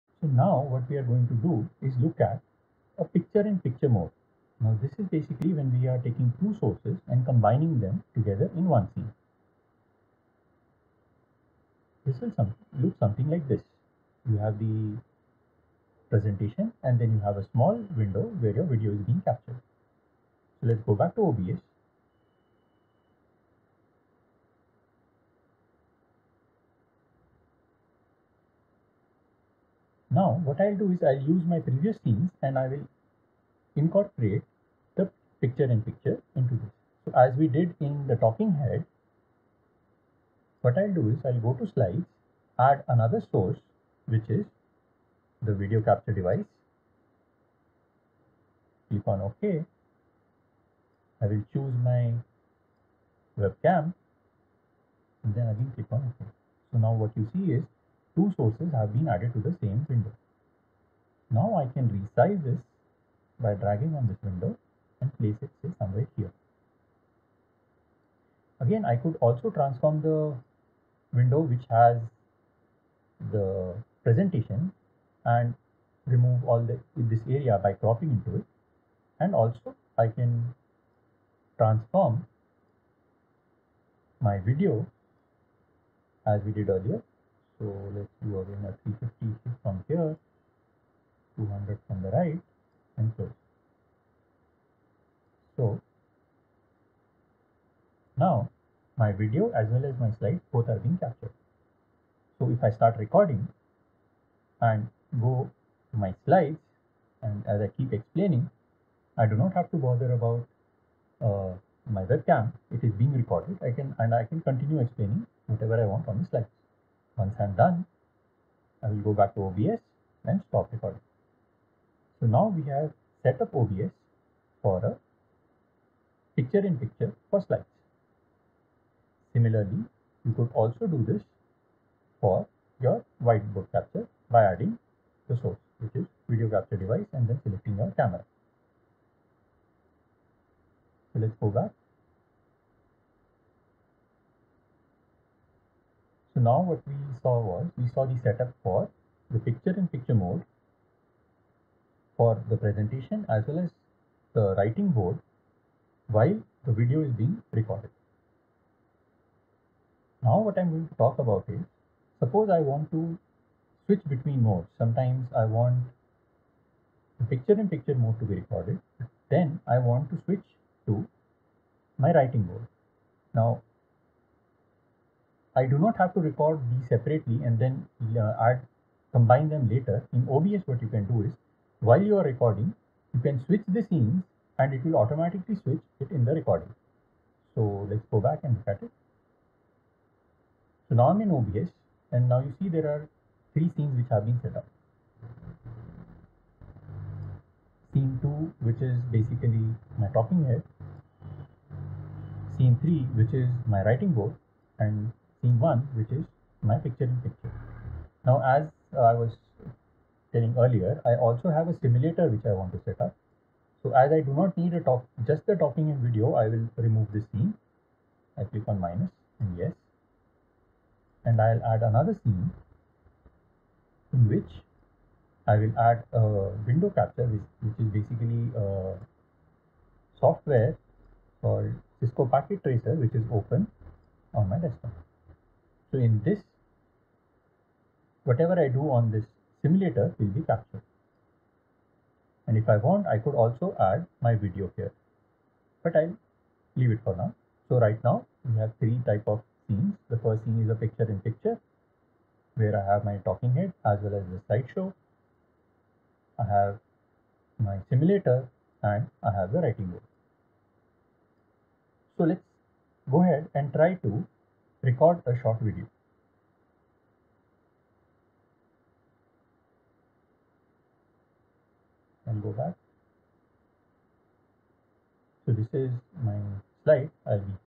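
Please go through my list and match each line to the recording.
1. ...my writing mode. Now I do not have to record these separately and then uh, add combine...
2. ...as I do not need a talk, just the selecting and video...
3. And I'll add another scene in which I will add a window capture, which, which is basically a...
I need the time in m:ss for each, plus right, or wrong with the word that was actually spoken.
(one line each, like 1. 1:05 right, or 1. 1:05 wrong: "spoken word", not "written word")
1. 2:51 right
2. 3:33 wrong: "talking", not "selecting"
3. 3:41 right.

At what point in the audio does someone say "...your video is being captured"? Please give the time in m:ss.
0:18.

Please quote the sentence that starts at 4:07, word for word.
So right now we have three type of scenes.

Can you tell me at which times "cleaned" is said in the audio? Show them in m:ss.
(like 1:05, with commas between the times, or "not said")
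not said.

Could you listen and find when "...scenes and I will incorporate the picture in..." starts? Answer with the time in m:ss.
0:32.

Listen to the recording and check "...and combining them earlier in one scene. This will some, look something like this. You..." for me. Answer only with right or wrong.
wrong.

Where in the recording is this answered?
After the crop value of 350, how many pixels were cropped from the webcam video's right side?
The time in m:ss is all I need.
1:31.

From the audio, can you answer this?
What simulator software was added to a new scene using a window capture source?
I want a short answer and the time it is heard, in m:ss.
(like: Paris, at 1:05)
Cisco Packet Tracer, at 3:51.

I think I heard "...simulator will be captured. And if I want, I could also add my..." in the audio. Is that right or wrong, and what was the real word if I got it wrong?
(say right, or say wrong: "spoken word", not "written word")
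right.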